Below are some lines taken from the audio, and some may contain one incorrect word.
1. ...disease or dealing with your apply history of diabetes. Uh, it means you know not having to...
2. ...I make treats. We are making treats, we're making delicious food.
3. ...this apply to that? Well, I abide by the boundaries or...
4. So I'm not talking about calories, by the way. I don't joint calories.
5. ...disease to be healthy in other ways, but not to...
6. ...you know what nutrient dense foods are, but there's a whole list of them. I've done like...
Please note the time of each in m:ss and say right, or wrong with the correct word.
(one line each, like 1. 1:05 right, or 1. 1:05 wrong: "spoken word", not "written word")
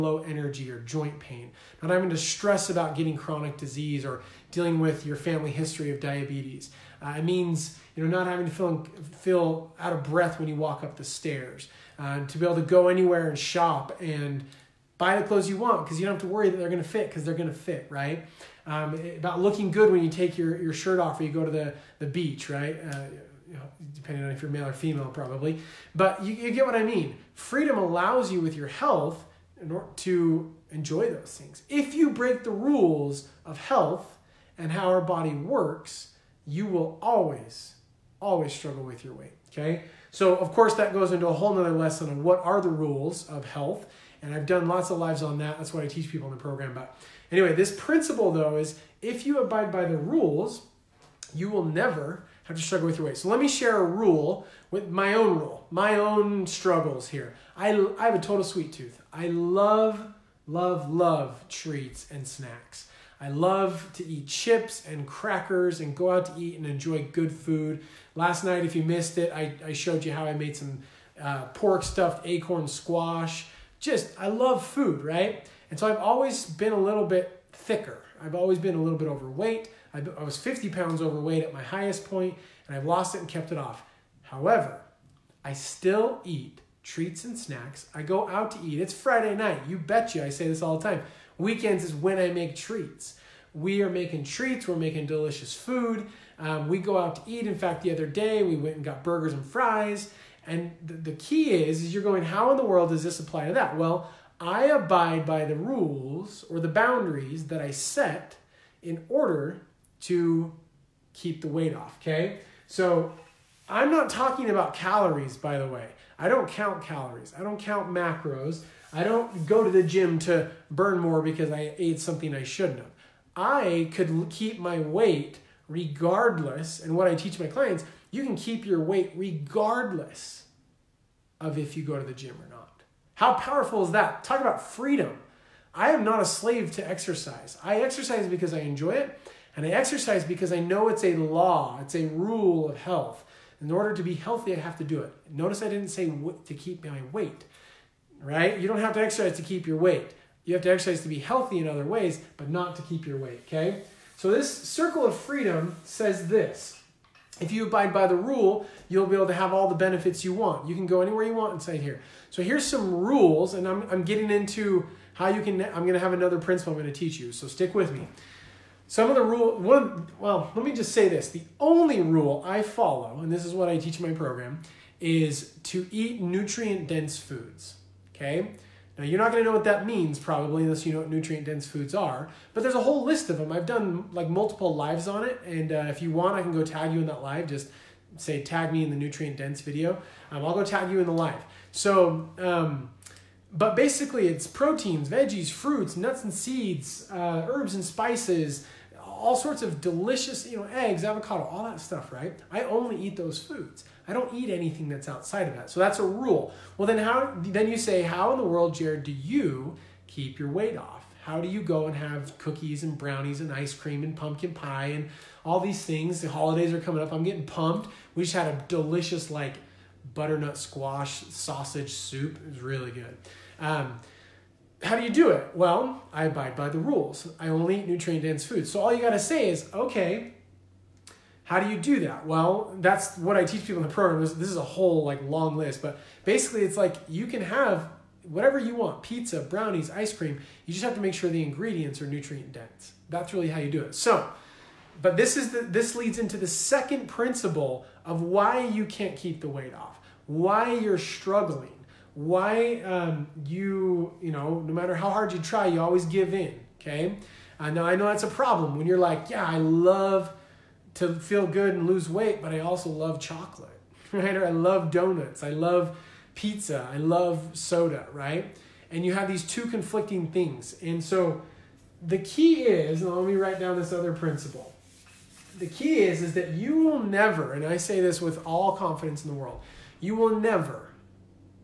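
1. 0:03 wrong: "family", not "apply"
2. 1:32 right
3. 1:43 wrong: "rules", not "boundaries"
4. 1:52 wrong: "count", not "joint"
5. 2:30 wrong: "exercise", not "disease"
6. 3:00 right.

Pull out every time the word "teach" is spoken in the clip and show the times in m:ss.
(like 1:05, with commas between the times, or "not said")
0:45, 2:07, 2:46, 2:53, 3:53.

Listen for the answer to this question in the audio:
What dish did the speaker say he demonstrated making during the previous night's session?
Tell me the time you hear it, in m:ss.
1:11.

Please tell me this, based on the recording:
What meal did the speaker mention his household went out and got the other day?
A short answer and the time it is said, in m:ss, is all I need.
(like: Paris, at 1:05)
burgers and fries, at 1:39.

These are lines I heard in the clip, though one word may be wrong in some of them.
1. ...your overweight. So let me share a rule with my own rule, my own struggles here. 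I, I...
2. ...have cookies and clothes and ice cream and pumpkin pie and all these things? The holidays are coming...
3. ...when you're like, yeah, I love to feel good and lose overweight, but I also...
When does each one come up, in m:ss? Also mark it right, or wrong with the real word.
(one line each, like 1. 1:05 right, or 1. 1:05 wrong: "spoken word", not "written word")
1. 0:52 wrong: "weight", not "overweight"
2. 3:31 wrong: "brownies", not "clothes"
3. 4:18 wrong: "weight", not "overweight".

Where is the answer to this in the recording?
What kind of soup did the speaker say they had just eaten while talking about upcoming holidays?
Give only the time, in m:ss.
3:40.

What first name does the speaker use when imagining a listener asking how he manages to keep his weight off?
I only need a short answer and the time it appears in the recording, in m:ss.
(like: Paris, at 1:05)
Jared, at 3:28.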